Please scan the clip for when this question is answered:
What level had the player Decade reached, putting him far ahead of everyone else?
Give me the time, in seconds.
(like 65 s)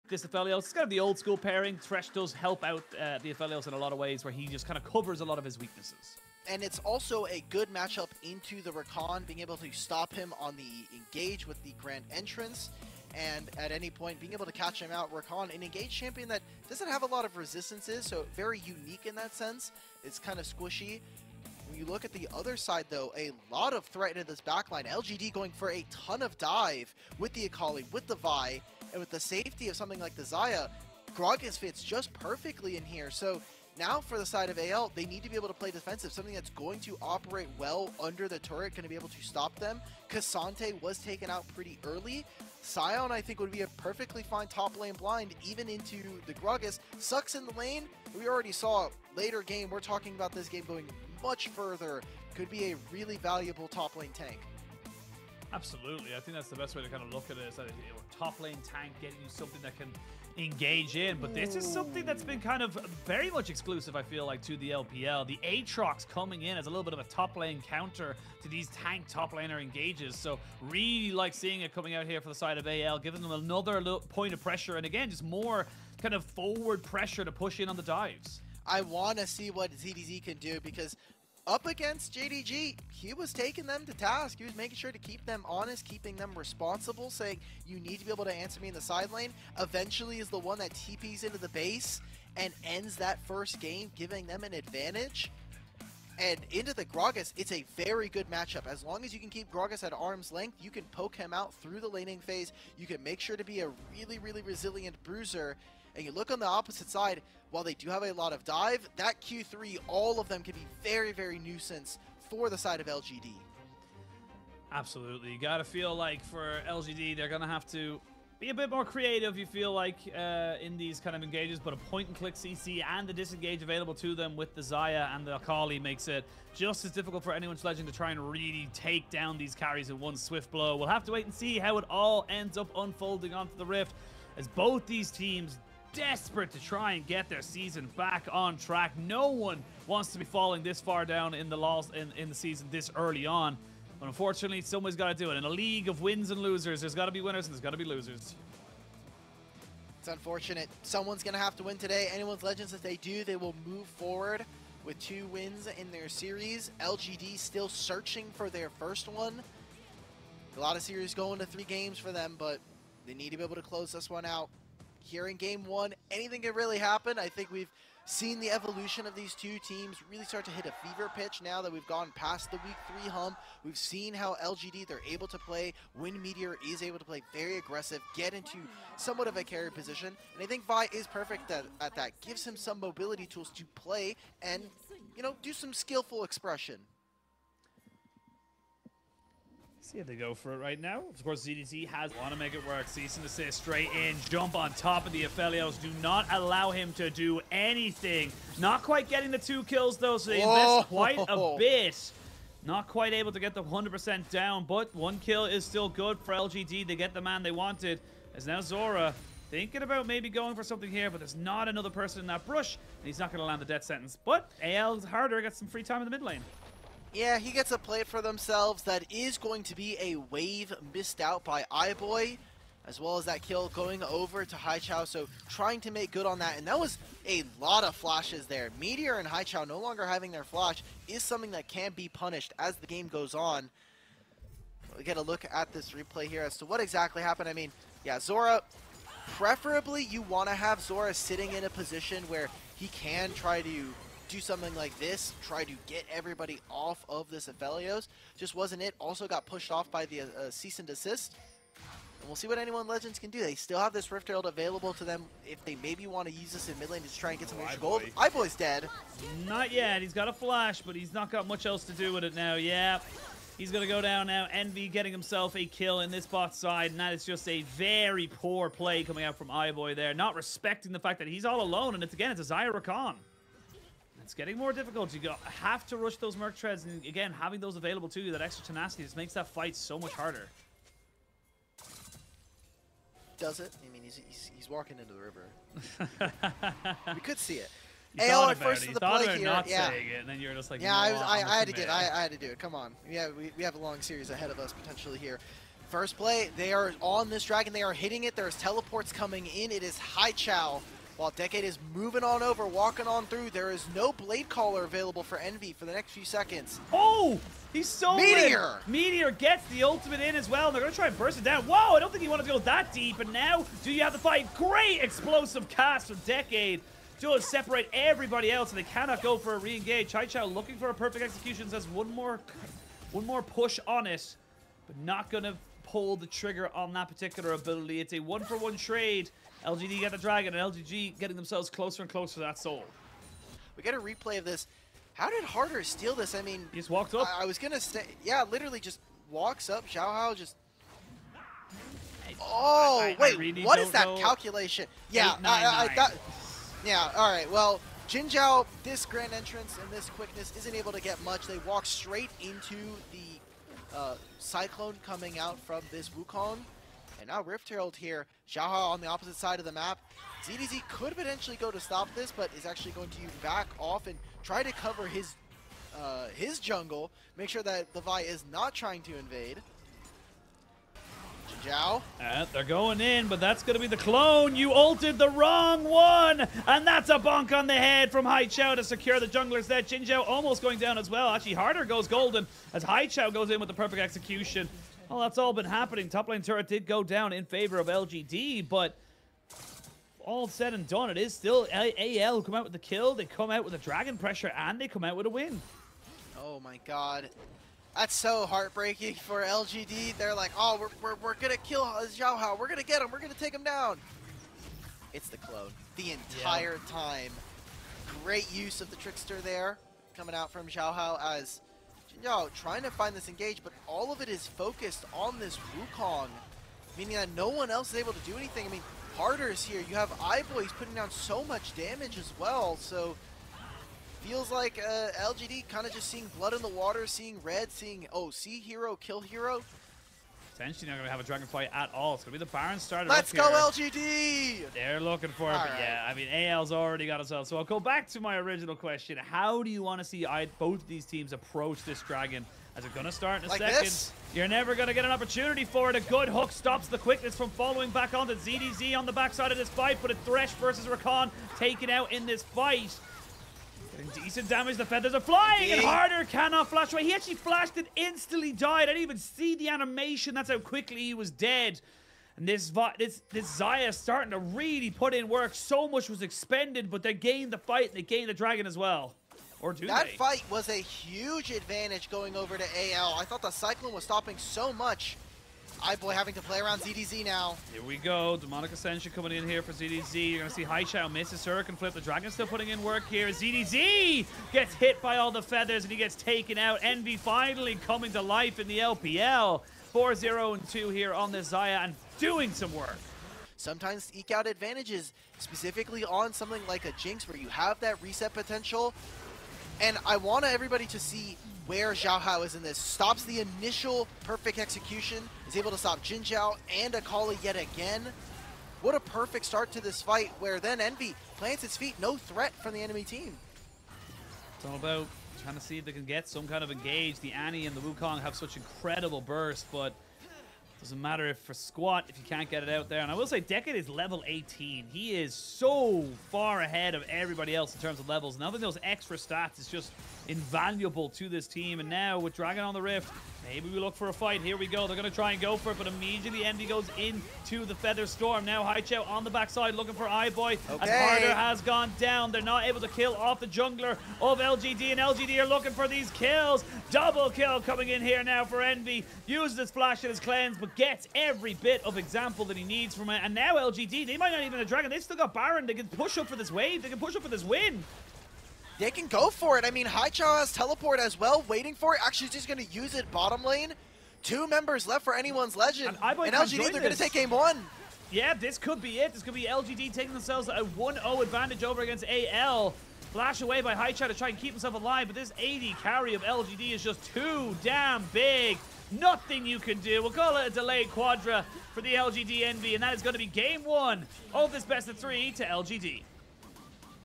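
523 s.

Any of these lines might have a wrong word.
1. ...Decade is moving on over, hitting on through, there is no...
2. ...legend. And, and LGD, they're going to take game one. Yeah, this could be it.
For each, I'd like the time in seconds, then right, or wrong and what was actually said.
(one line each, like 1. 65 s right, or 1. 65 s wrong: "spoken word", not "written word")
1. 301 s wrong: "walking", not "hitting"
2. 565 s right.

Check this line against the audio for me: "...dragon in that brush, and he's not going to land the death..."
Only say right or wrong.
wrong.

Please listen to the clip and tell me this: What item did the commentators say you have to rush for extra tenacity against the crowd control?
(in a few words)
Merc Treads.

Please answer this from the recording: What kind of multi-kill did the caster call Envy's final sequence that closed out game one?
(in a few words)
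Delayed quadra.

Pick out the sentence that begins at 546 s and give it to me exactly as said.
Double kill coming in here now for Envy.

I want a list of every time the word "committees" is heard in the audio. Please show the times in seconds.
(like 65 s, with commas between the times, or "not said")
not said.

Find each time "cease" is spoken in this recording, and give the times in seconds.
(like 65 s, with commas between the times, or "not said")
192 s, 250 s.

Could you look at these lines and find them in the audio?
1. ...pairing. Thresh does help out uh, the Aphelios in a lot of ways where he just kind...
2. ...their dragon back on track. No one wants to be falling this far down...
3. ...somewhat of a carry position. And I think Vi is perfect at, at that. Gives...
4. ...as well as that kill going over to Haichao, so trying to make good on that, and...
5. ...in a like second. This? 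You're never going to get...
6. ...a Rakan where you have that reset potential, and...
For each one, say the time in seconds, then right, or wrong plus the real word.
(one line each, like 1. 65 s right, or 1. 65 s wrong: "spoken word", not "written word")
1. 1 s right
2. 137 s wrong: "season", not "dragon"
3. 178 s right
4. 222 s right
5. 443 s right
6. 496 s wrong: "Jinx", not "Rakan".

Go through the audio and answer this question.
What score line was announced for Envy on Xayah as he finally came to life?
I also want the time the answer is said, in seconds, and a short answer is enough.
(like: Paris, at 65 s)
4-0-2, at 489 s.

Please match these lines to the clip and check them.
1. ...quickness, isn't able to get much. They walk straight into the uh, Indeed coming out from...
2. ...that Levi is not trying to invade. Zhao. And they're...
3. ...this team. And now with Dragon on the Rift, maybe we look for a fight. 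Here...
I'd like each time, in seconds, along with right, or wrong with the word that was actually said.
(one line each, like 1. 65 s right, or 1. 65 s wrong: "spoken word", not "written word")
1. 350 s wrong: "Cyclone", not "Indeed"
2. 367 s right
3. 531 s right.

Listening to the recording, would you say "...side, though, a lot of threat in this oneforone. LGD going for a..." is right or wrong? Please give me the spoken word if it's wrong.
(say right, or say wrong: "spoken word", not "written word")
wrong: "backline", not "oneforone".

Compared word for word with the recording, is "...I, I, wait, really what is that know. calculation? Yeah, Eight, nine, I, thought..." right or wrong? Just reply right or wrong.
right.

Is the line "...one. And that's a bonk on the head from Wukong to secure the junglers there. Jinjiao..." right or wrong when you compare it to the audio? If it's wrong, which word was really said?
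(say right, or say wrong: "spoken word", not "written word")
wrong: "Haichao", not "Wukong".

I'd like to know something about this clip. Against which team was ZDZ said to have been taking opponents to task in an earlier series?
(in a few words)
JDG.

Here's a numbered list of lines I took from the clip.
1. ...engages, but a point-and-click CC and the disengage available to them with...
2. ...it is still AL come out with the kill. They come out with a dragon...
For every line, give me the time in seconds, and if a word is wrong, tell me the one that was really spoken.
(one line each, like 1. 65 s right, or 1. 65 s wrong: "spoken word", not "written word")
1. 121 s right
2. 391 s right.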